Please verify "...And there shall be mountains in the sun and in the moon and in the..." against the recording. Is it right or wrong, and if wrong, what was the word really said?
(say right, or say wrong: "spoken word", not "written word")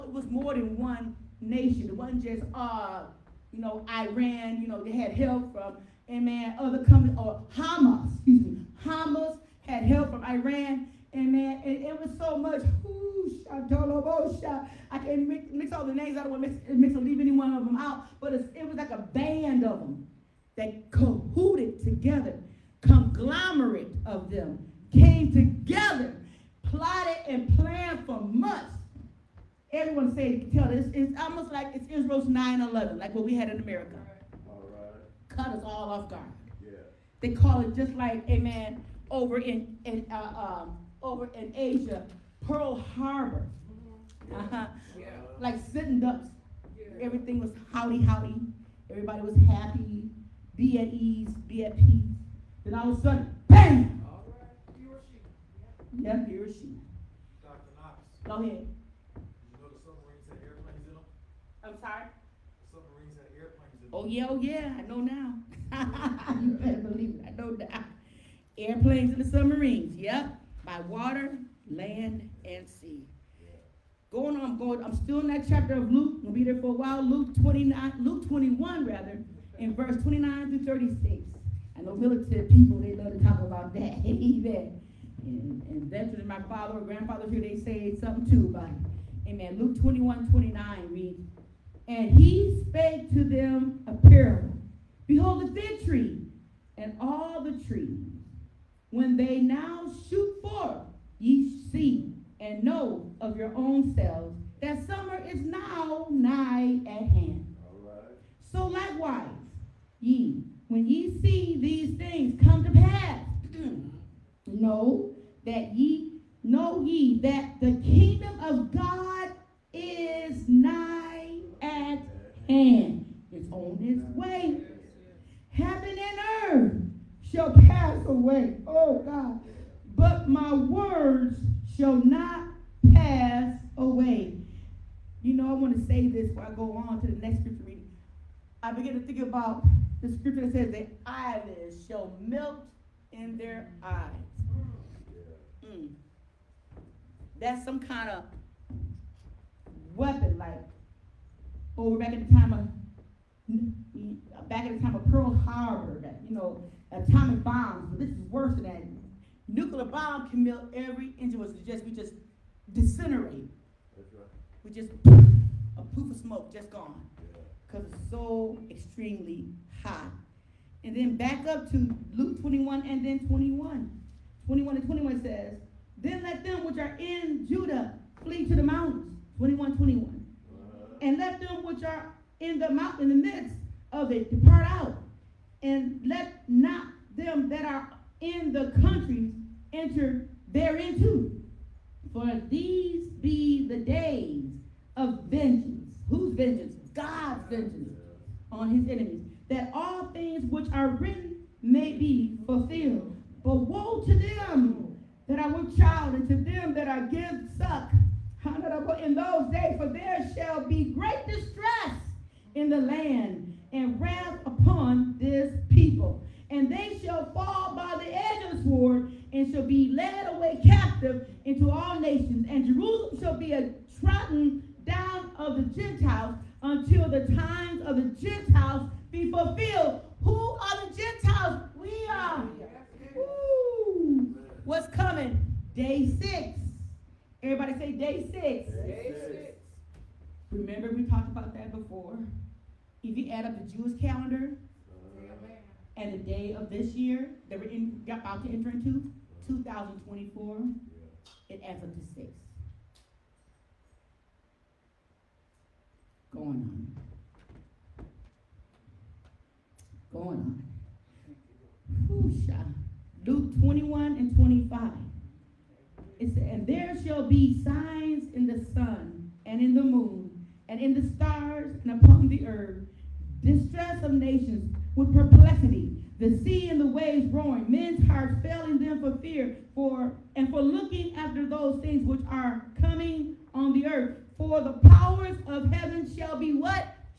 wrong: "signs", not "mountains".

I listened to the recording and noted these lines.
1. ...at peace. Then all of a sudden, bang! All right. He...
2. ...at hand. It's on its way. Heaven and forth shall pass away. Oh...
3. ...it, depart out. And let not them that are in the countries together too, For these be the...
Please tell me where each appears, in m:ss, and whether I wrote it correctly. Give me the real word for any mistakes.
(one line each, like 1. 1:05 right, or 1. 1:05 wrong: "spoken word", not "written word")
1. 0:51 right
2. 2:01 wrong: "earth", not "forth"
3. 3:04 wrong: "enter", not "together".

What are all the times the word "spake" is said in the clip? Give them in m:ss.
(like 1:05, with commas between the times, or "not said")
1:32.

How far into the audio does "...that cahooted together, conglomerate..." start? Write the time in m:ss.
0:20.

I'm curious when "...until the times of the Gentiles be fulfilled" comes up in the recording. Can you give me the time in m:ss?
3:46.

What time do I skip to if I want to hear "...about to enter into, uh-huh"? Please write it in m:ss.
4:08.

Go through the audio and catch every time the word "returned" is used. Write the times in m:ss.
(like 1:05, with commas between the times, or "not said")
not said.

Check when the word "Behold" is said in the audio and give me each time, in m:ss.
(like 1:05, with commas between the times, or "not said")
1:35.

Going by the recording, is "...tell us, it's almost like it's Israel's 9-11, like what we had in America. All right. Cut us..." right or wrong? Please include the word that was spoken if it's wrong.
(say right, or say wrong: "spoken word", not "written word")
right.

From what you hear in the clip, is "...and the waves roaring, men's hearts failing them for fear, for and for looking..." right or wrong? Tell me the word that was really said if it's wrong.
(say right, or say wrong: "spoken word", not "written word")
right.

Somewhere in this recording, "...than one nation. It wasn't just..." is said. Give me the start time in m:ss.
0:00.